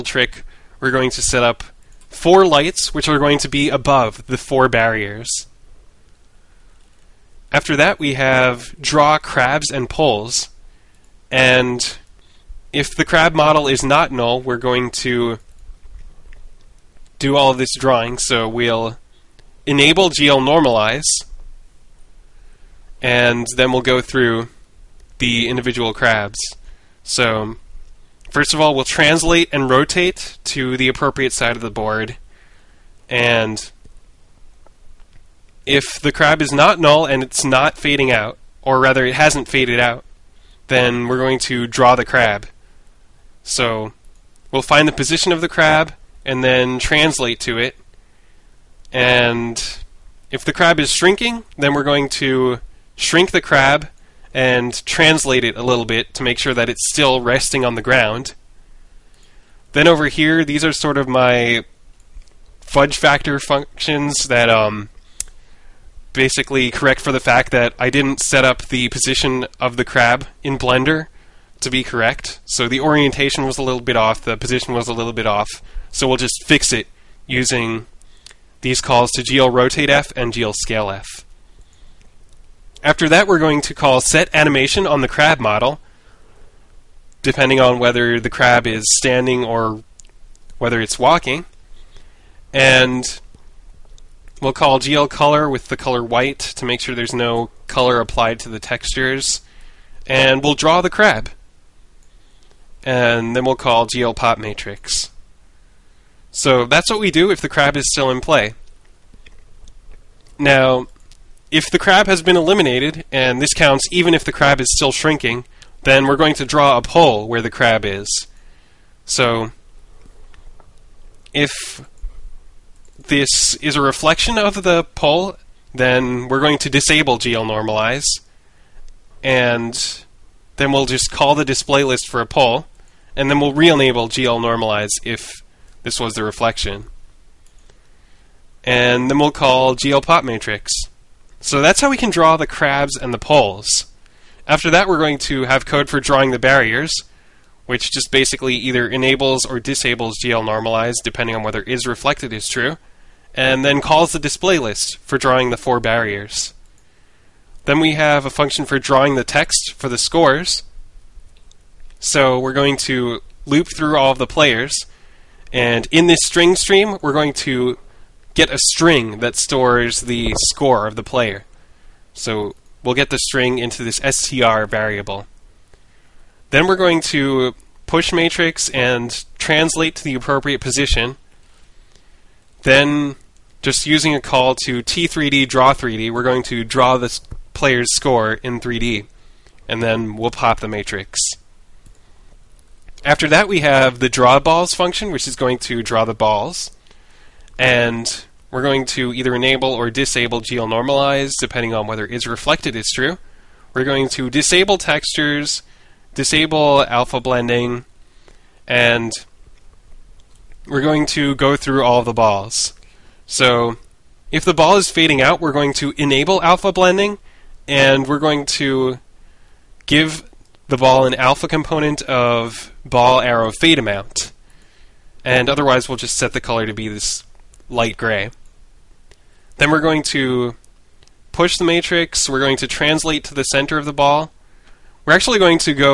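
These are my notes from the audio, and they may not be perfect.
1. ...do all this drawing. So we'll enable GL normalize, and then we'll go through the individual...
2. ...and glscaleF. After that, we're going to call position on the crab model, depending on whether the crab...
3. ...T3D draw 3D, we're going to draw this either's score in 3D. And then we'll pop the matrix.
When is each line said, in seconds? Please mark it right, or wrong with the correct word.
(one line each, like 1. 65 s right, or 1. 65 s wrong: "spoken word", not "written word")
1. 17 s right
2. 80 s wrong: "setAnimation", not "position"
3. 184 s wrong: "player", not "either".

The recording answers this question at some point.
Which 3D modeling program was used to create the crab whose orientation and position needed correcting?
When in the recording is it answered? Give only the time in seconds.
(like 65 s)
70 s.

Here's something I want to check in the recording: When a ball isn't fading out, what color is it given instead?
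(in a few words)
Light gray.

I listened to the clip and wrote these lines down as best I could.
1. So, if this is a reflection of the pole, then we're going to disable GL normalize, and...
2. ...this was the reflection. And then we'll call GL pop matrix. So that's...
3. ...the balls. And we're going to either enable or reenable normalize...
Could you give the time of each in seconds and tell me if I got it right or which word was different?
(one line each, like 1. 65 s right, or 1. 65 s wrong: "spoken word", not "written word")
1. 119 s right
2. 135 s right
3. 196 s wrong: "disable", not "reenable".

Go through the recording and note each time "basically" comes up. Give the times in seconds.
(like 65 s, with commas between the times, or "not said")
66 s, 148 s.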